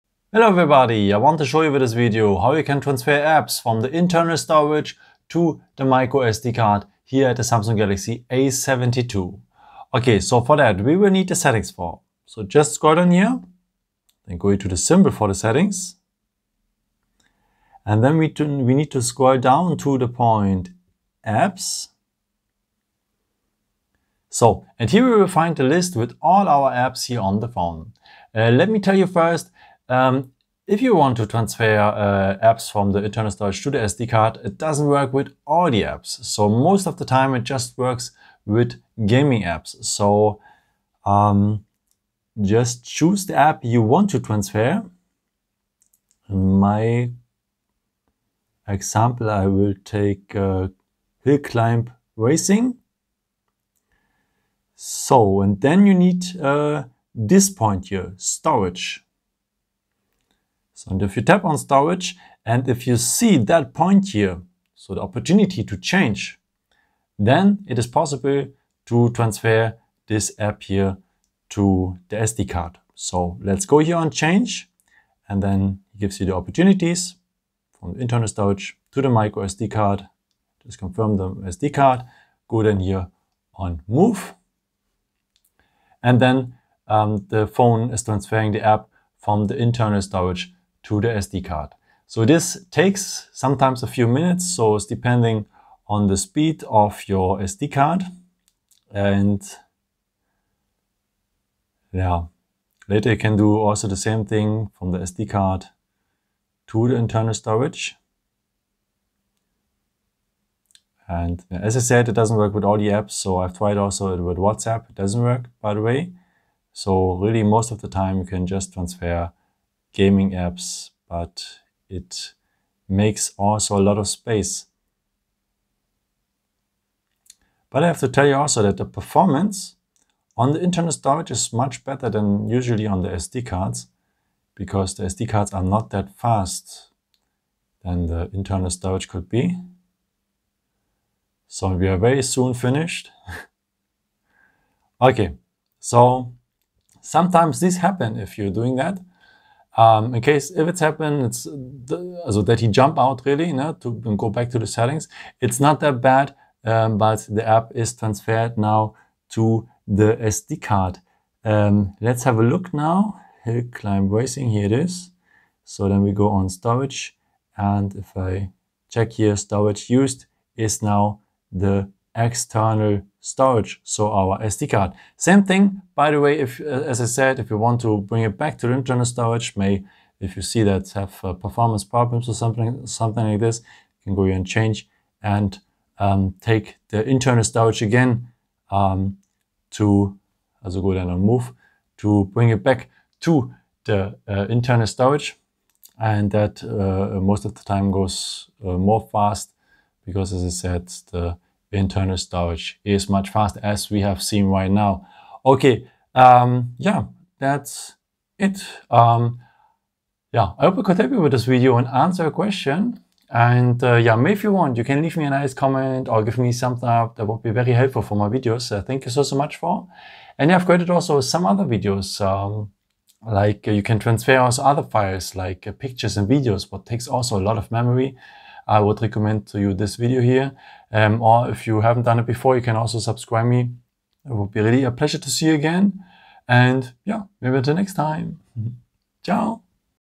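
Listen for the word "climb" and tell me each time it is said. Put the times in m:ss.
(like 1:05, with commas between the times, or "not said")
0:51, 2:43.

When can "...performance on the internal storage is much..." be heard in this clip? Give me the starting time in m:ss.
2:08.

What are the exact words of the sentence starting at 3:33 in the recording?
And uh, yeah, maybe if you want, you can leave me a nice comment or give me something up.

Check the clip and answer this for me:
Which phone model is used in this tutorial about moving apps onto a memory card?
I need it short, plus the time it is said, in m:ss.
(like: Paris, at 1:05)
Samsung Galaxy A72, at 0:07.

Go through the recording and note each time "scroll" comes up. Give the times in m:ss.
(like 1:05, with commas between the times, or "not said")
0:12, 0:19.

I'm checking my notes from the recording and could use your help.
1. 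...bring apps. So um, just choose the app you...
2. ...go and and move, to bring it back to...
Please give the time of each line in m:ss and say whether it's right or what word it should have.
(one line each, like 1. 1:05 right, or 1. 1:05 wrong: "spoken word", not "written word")
1. 0:39 wrong: "gaming", not "bring"
2. 3:10 right.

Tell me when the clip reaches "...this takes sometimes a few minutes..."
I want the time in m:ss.
1:32.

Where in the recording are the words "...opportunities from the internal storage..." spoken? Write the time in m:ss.
1:16.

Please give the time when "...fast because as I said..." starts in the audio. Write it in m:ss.
3:19.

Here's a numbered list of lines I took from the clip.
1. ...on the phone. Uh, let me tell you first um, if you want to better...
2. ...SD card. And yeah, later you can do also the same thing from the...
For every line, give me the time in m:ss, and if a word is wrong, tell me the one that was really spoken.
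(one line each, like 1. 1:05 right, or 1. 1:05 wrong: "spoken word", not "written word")
1. 0:27 wrong: "transfer", not "better"
2. 1:37 right.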